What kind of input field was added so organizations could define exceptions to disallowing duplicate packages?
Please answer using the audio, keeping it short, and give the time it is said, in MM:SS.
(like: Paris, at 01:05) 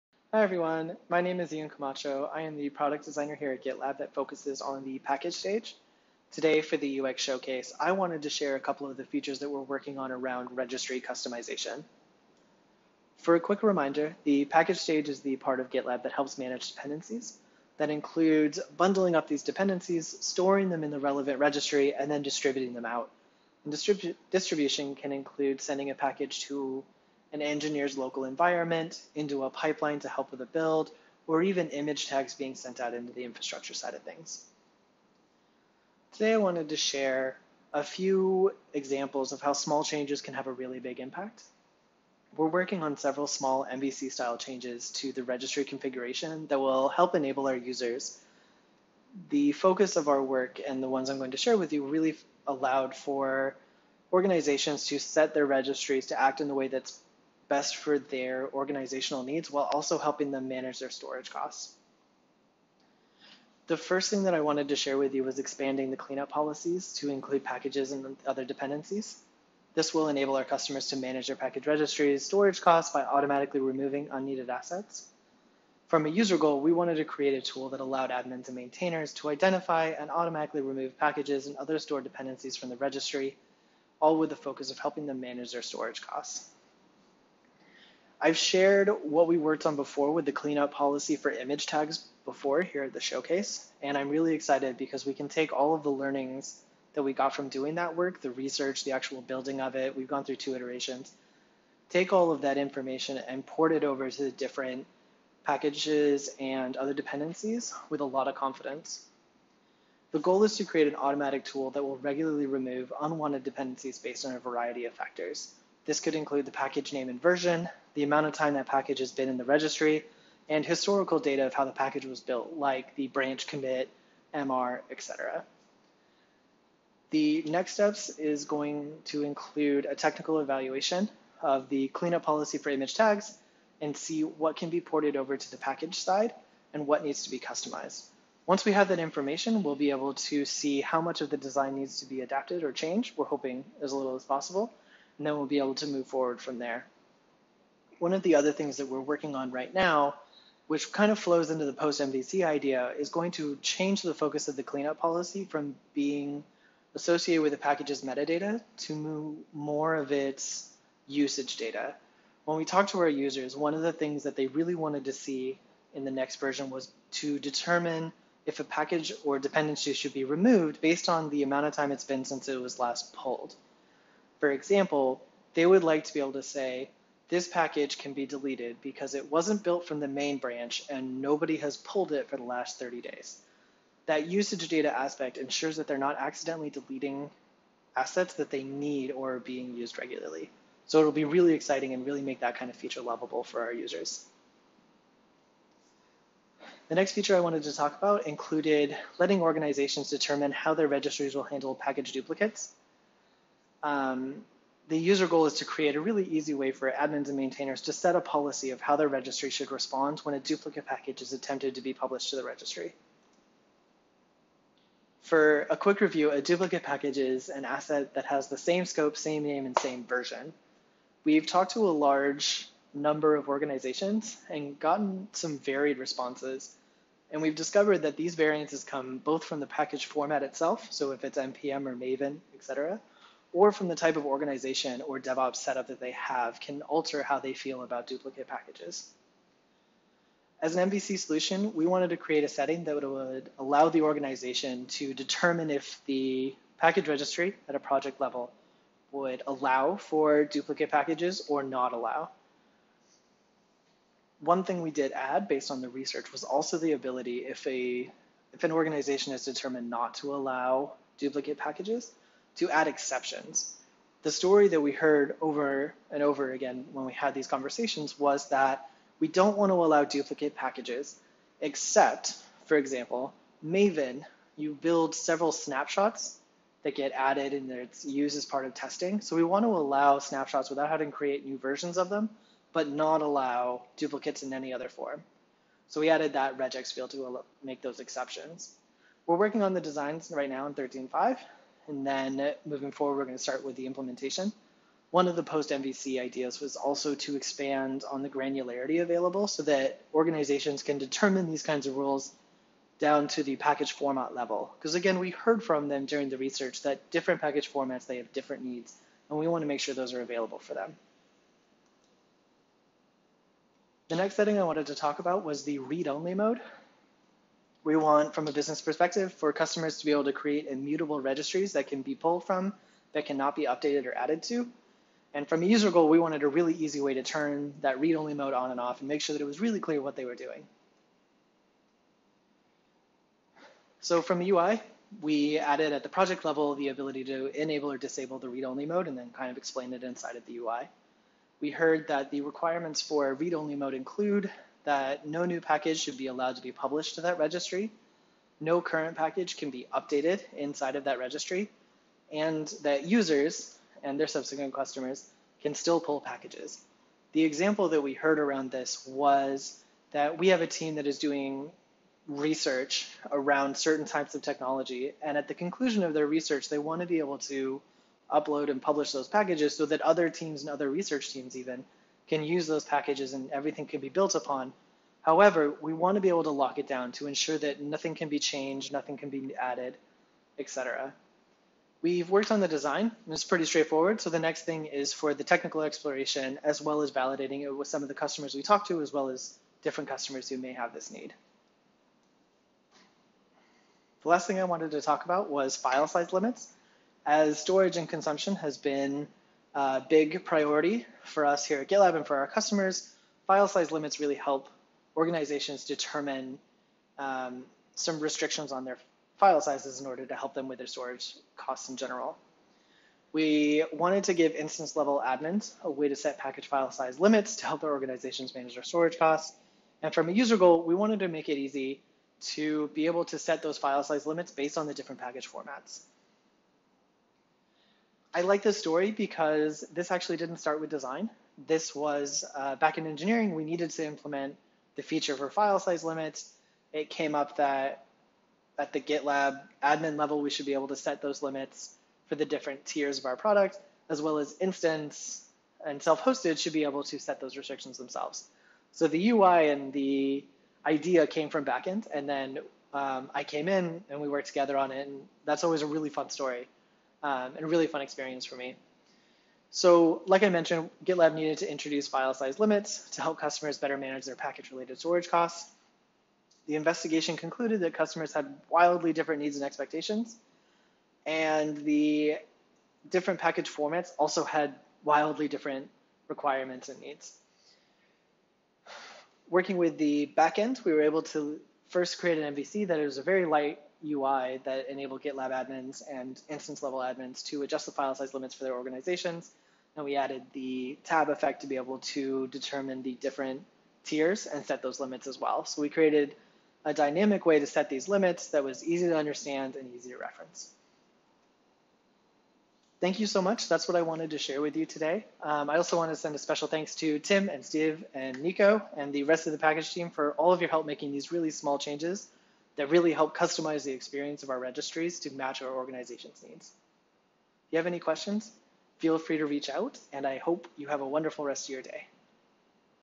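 regex field, at 04:46.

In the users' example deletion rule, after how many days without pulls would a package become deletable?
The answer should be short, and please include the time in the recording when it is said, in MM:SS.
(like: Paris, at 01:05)
30 days, at 03:02.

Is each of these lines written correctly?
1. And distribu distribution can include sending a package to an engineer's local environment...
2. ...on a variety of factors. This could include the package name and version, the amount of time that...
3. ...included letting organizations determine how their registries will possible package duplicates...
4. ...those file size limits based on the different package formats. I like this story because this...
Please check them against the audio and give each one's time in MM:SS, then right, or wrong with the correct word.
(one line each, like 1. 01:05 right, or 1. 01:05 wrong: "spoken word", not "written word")
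1. 00:23 right
2. 01:54 right
3. 03:18 wrong: "handle", not "possible"
4. 07:03 right.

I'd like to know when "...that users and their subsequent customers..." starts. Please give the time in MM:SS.
05:52.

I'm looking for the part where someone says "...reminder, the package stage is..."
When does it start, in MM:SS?
00:13.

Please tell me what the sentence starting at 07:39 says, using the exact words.
So like I mentioned, GitLab needed to introduce file size limits to help customers better manage their package-related storage costs.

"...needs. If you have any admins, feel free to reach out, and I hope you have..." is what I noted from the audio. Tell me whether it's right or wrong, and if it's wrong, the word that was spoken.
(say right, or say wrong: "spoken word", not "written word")
wrong: "questions", not "admins".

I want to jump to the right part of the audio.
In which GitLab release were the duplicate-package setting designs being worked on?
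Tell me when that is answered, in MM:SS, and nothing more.
04:50.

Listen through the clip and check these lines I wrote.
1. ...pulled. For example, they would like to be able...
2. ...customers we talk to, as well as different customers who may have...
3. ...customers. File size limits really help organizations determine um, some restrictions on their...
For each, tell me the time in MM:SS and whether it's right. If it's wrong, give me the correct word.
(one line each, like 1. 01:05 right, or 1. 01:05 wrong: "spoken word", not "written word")
1. 02:53 right
2. 06:28 right
3. 06:42 right.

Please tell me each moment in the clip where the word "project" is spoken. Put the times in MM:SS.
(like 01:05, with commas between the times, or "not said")
04:07, 05:36.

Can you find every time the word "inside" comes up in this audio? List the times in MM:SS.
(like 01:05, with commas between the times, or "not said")
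05:40, 05:50.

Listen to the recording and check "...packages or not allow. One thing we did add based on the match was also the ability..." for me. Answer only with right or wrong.
wrong.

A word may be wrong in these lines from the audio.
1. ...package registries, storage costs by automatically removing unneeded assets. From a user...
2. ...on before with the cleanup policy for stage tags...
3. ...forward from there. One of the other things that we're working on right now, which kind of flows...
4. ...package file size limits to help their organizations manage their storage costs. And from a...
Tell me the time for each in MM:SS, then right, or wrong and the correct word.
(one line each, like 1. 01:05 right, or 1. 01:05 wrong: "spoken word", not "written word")
1. 01:11 right
2. 01:29 wrong: "image", not "stage"
3. 02:26 right
4. 06:56 right.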